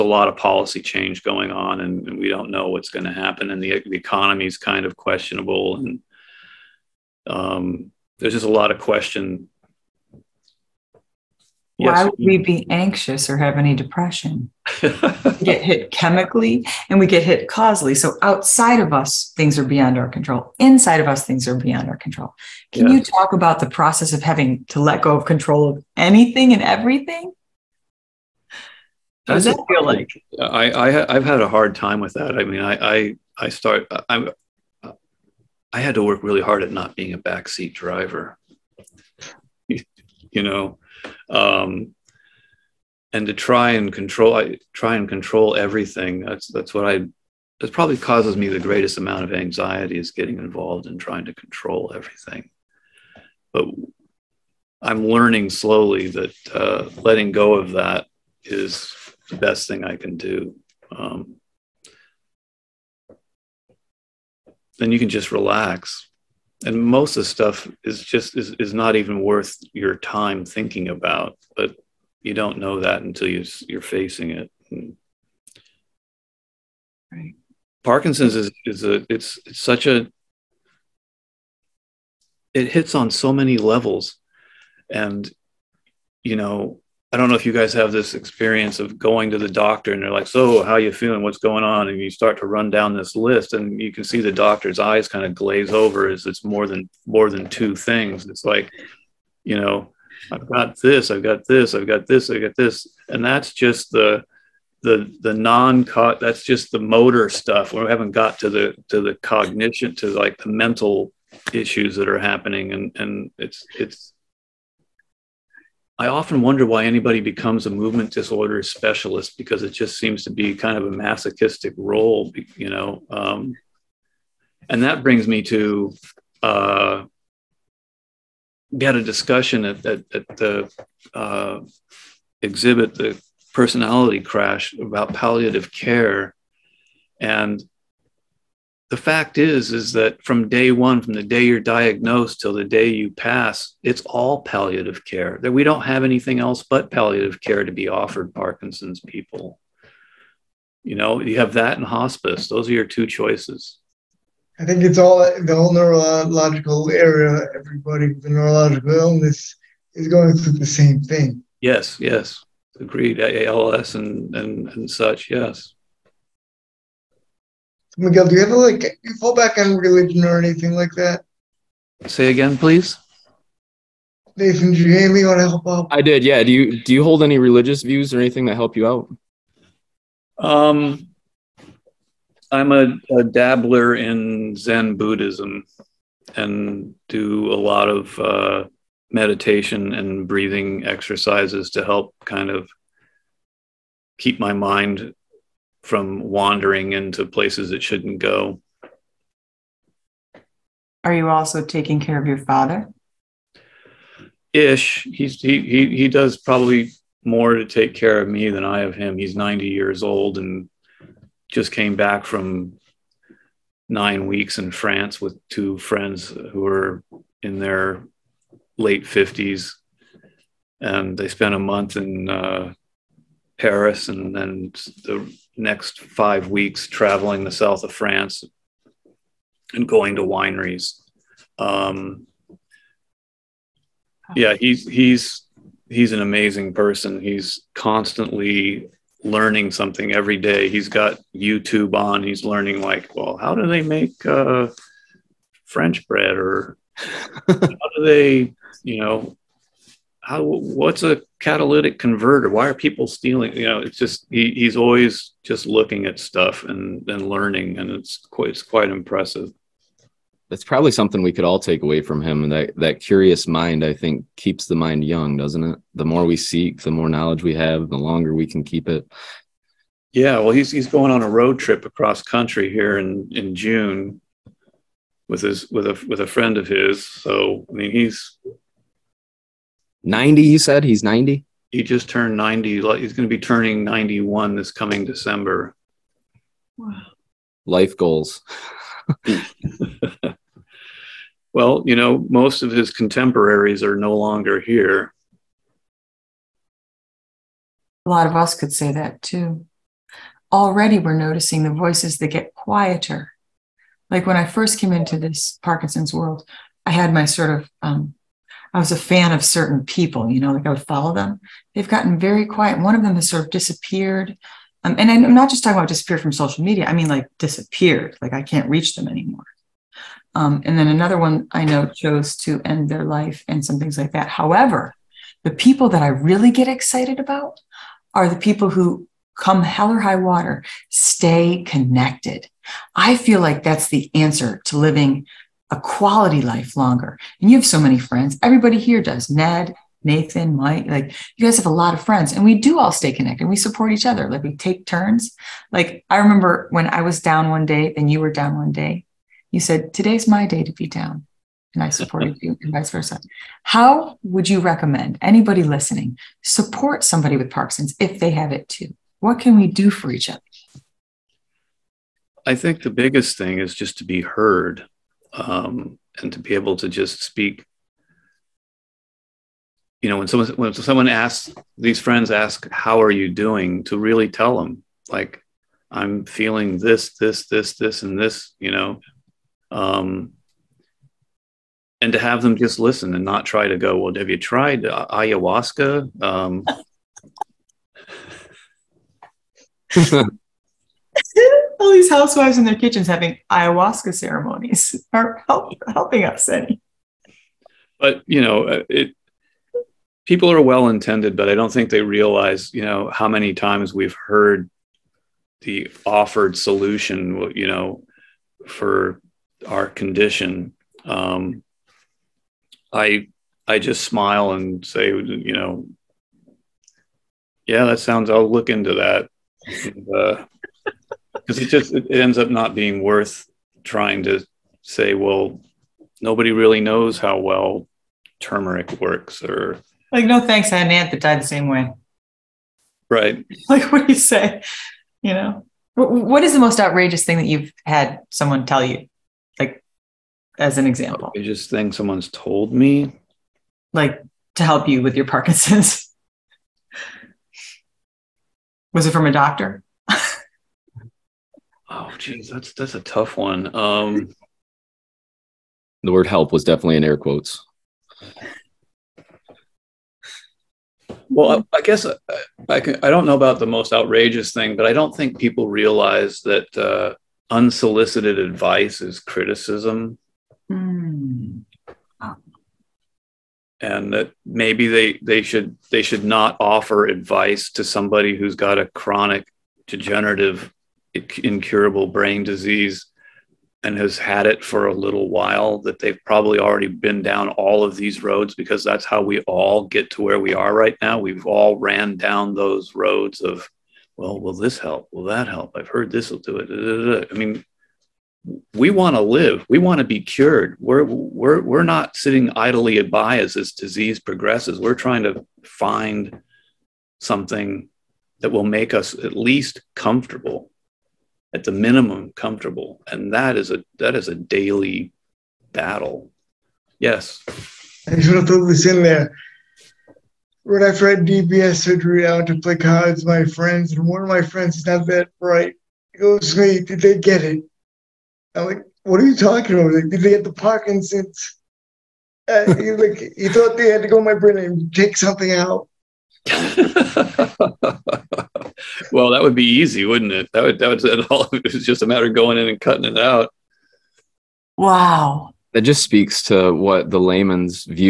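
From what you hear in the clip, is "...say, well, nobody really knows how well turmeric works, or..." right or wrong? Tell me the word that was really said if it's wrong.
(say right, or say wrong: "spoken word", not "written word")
right.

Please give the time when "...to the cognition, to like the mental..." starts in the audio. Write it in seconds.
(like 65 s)
108 s.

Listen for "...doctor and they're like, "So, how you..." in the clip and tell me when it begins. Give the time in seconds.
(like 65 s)
89 s.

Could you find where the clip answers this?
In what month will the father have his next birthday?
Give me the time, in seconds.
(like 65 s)
285 s.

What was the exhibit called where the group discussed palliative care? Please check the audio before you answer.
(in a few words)
the personality crash.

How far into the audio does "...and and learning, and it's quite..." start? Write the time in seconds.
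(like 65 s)
256 s.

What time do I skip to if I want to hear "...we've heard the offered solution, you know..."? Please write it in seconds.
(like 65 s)
403 s.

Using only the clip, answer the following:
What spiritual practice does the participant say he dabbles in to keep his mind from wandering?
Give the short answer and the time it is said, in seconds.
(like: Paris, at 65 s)
Zen Buddhism, at 184 s.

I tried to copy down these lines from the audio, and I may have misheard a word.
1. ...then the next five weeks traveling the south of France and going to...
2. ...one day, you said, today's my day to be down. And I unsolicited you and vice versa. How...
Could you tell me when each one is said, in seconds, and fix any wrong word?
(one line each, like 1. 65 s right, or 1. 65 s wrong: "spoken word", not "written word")
1. 224 s right
2. 348 s wrong: "supported", not "unsolicited".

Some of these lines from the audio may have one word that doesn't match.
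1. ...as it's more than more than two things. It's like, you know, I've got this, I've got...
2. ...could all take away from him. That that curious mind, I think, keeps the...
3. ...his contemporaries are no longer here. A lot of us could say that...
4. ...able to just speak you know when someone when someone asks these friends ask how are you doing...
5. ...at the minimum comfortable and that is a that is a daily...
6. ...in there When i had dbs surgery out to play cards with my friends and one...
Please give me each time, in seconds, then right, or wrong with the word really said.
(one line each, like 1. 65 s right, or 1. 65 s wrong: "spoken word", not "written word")
1. 96 s right
2. 261 s right
3. 292 s right
4. 366 s right
5. 511 s right
6. 518 s right.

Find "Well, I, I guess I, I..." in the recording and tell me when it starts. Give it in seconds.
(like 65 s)
461 s.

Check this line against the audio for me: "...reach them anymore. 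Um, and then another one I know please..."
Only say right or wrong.
wrong.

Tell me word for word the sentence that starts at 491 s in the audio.
We've all ran down those roads of, well, will this help?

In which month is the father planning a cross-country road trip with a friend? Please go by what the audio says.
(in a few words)
June.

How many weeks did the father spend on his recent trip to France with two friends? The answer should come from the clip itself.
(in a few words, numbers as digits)
9.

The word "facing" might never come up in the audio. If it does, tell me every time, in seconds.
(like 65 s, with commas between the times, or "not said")
73 s.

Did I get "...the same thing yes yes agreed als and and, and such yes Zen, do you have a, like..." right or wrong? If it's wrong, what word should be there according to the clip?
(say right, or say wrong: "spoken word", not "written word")
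wrong: "Miguel", not "Zen".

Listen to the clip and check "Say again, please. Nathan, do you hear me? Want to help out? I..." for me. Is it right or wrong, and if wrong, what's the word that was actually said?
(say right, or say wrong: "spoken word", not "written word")
right.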